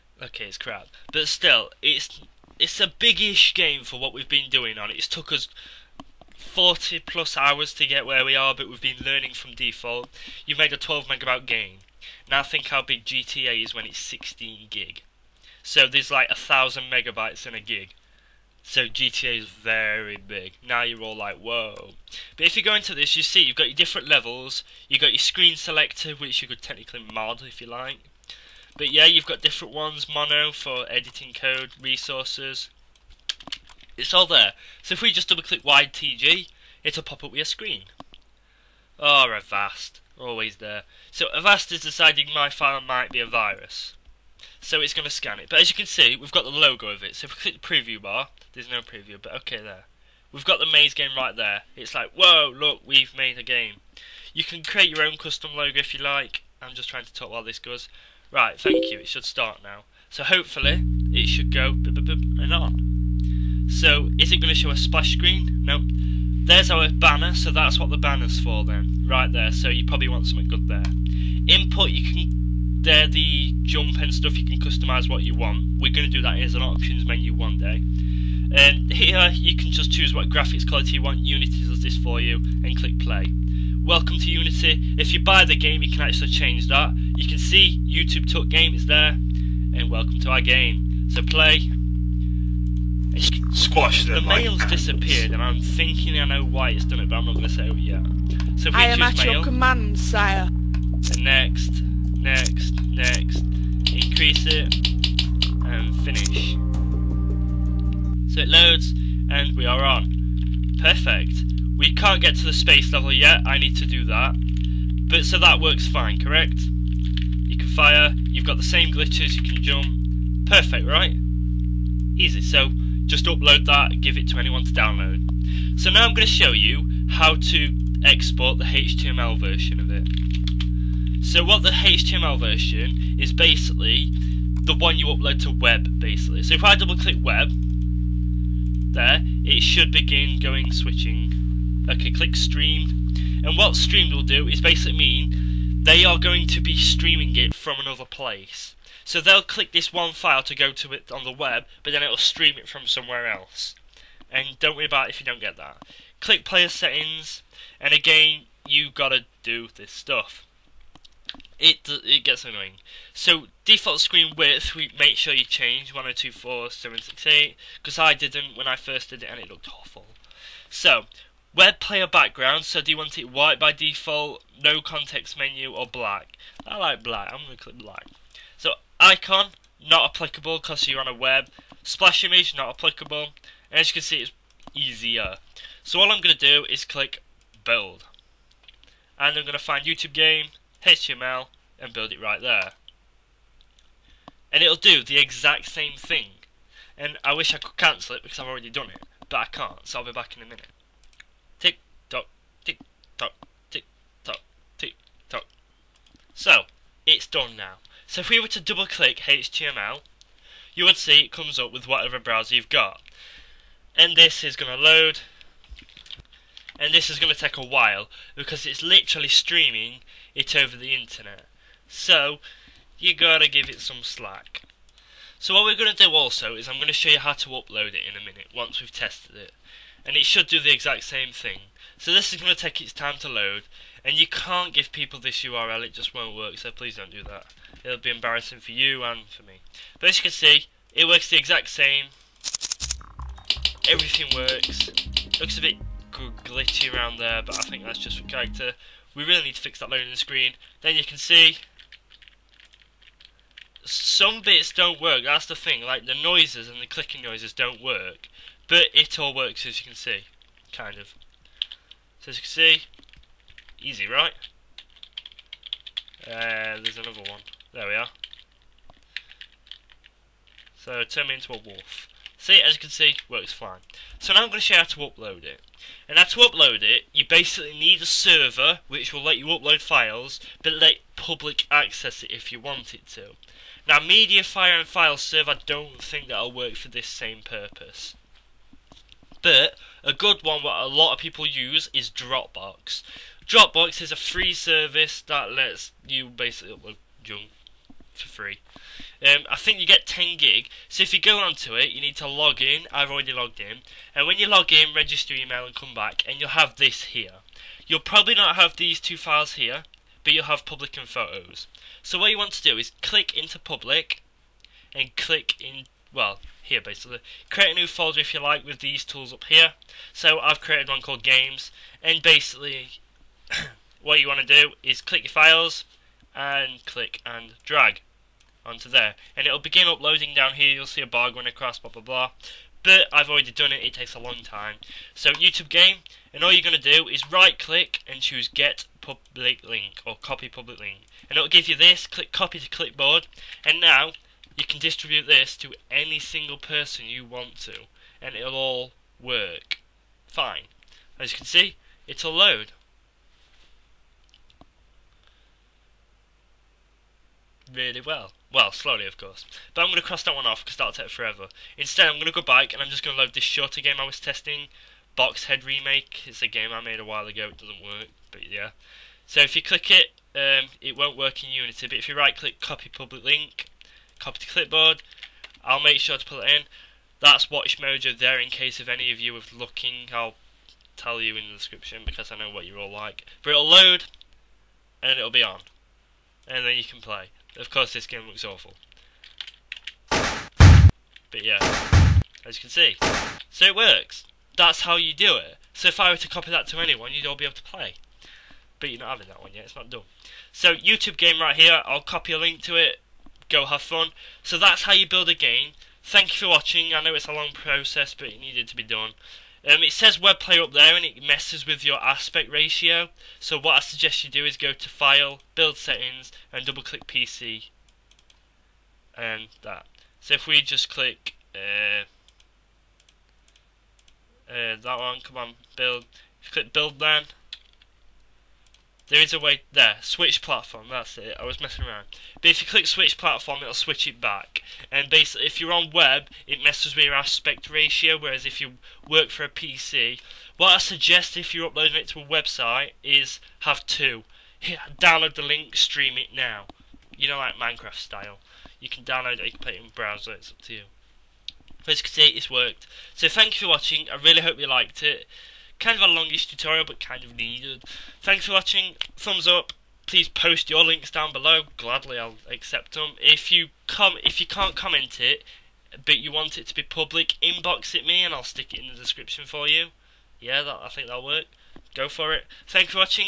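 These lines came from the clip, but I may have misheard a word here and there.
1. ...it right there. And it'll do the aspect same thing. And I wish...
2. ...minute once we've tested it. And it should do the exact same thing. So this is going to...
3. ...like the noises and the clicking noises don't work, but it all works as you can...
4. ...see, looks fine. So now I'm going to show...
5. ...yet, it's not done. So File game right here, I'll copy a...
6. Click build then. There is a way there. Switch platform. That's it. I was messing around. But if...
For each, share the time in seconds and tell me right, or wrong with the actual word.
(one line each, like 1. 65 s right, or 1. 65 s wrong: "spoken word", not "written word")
1. 192 s wrong: "exact", not "aspect"
2. 228 s right
3. 255 s right
4. 272 s wrong: "works", not "looks"
5. 399 s wrong: "YouTube", not "File"
6. 426 s right.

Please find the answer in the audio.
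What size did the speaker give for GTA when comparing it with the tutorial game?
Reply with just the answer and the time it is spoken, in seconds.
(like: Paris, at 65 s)
16 gig, at 13 s.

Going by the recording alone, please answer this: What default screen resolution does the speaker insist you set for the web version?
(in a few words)
1024 by 768.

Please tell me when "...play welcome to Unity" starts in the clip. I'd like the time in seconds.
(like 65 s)
82 s.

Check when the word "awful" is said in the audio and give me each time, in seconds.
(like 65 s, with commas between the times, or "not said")
169 s, 388 s.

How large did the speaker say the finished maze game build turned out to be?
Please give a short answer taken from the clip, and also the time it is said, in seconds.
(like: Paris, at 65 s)
12 megabytes, at 10 s.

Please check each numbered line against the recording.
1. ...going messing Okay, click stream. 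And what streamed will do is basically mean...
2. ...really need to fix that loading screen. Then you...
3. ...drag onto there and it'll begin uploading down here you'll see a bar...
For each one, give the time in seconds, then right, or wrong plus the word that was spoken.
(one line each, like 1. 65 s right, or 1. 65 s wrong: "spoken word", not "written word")
1. 140 s wrong: "switching", not "messing"
2. 249 s right
3. 327 s right.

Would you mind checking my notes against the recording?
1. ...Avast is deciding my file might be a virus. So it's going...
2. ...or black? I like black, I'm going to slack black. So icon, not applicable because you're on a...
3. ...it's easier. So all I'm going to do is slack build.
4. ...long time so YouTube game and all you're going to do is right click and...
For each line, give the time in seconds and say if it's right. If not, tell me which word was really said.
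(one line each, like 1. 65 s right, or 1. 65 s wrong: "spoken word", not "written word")
1. 41 s right
2. 175 s wrong: "click", not "slack"
3. 184 s wrong: "click", not "slack"
4. 334 s right.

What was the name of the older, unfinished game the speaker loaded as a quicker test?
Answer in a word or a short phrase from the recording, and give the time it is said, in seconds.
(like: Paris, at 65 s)
Box Head Remake, at 365 s.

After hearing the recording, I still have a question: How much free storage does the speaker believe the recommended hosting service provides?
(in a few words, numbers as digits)
10 gig.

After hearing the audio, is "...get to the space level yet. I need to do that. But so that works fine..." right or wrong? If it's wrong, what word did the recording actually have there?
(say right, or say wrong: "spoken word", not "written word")
right.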